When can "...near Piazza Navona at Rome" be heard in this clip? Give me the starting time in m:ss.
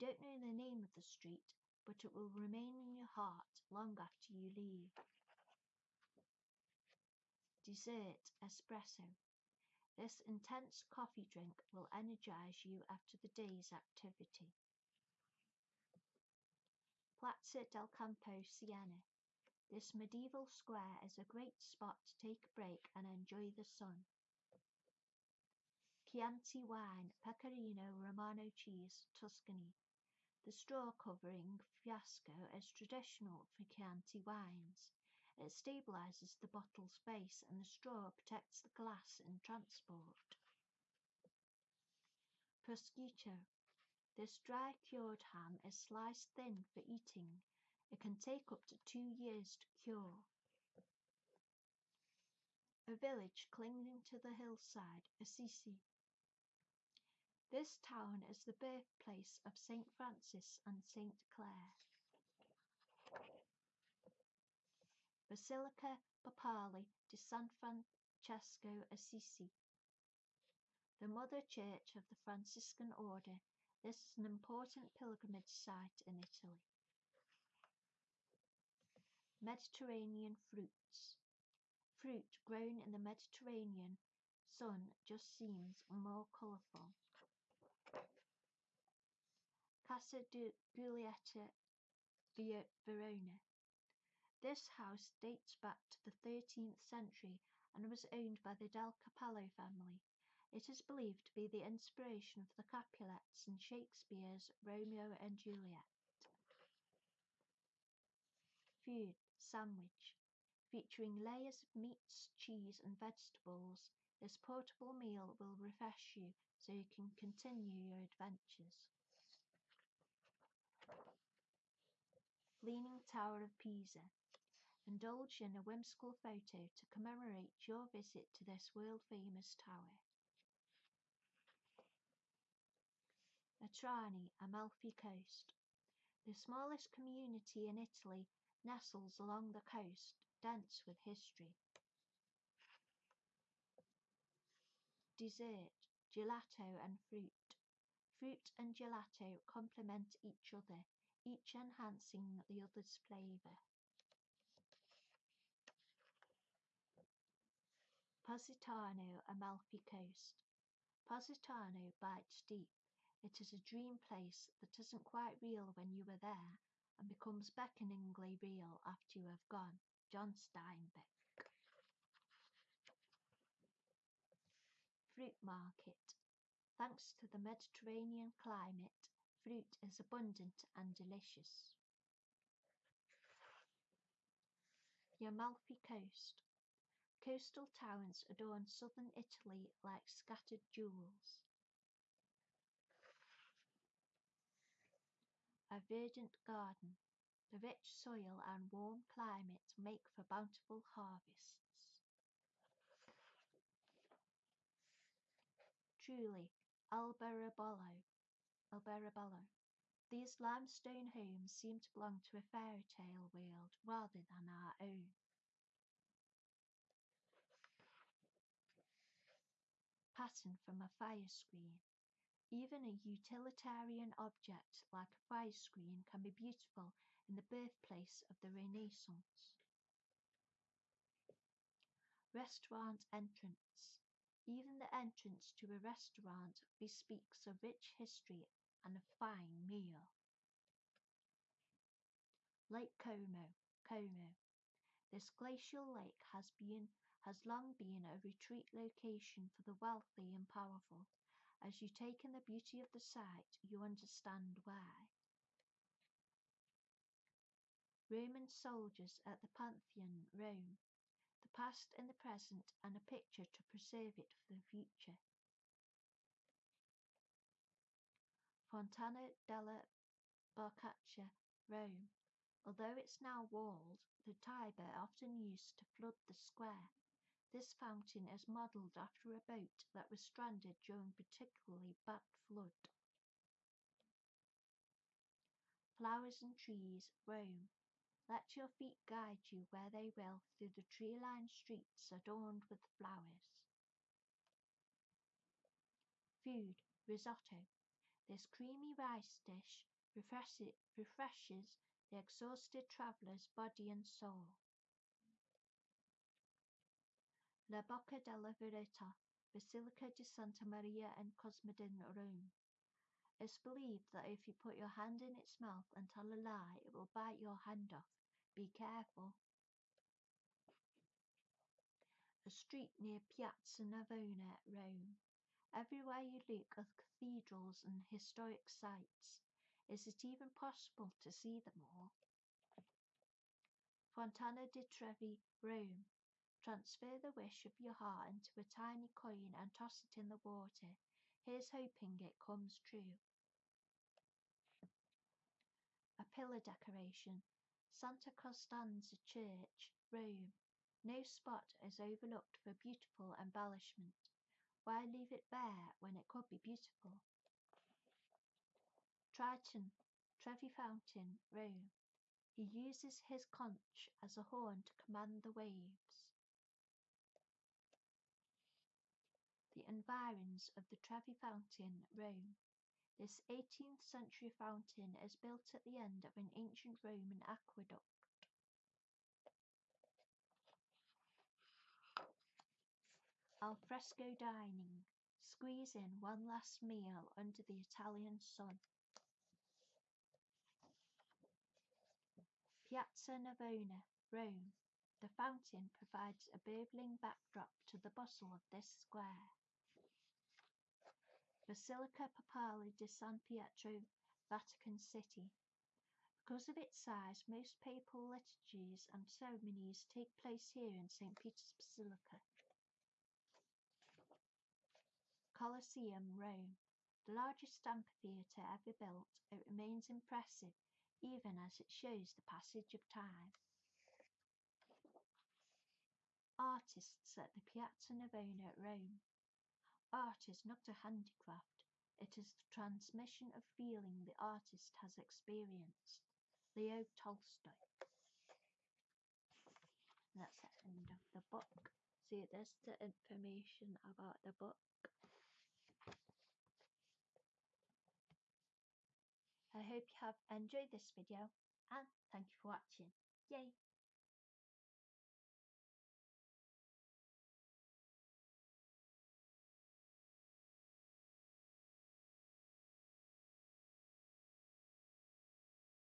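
5:22.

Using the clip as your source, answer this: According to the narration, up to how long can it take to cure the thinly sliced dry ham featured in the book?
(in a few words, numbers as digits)
2 years.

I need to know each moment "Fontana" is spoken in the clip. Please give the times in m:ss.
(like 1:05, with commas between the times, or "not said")
4:28, 5:34.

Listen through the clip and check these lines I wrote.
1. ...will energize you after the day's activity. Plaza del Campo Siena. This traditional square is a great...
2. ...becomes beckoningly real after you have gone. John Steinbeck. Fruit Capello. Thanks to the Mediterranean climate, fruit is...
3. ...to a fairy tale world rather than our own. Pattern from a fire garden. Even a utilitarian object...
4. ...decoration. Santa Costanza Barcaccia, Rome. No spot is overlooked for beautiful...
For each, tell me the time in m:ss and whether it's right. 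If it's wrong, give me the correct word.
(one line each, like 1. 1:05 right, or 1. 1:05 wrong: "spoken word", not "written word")
1. 0:11 wrong: "medieval", not "traditional"
2. 2:47 wrong: "Market", not "Capello"
3. 3:32 wrong: "screen", not "garden"
4. 5:46 wrong: "Church", not "Barcaccia".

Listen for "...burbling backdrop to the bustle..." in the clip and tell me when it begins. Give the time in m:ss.
6:36.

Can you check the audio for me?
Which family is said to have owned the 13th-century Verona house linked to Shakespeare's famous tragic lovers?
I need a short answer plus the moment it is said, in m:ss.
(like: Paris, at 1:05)
Del Capello, at 1:38.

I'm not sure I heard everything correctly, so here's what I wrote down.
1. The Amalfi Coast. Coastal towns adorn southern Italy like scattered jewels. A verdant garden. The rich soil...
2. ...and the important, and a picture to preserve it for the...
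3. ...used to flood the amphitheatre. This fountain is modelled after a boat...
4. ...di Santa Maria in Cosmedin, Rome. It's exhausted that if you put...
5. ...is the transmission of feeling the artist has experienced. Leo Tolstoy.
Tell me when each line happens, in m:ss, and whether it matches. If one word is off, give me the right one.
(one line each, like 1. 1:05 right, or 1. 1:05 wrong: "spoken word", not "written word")
1. 3:05 right
2. 4:21 wrong: "present", not "important"
3. 4:35 wrong: "square", not "amphitheatre"
4. 5:10 wrong: "believed", not "exhausted"
5. 7:12 right.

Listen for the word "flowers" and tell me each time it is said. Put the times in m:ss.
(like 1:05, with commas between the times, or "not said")
4:45, 4:52.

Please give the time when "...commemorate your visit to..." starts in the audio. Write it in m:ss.
2:06.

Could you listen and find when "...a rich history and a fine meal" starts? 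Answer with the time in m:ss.
3:57.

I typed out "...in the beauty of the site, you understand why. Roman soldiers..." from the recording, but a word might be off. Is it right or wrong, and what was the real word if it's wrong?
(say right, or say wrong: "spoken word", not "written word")
right.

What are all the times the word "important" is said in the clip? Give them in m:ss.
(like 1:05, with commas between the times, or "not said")
1:14.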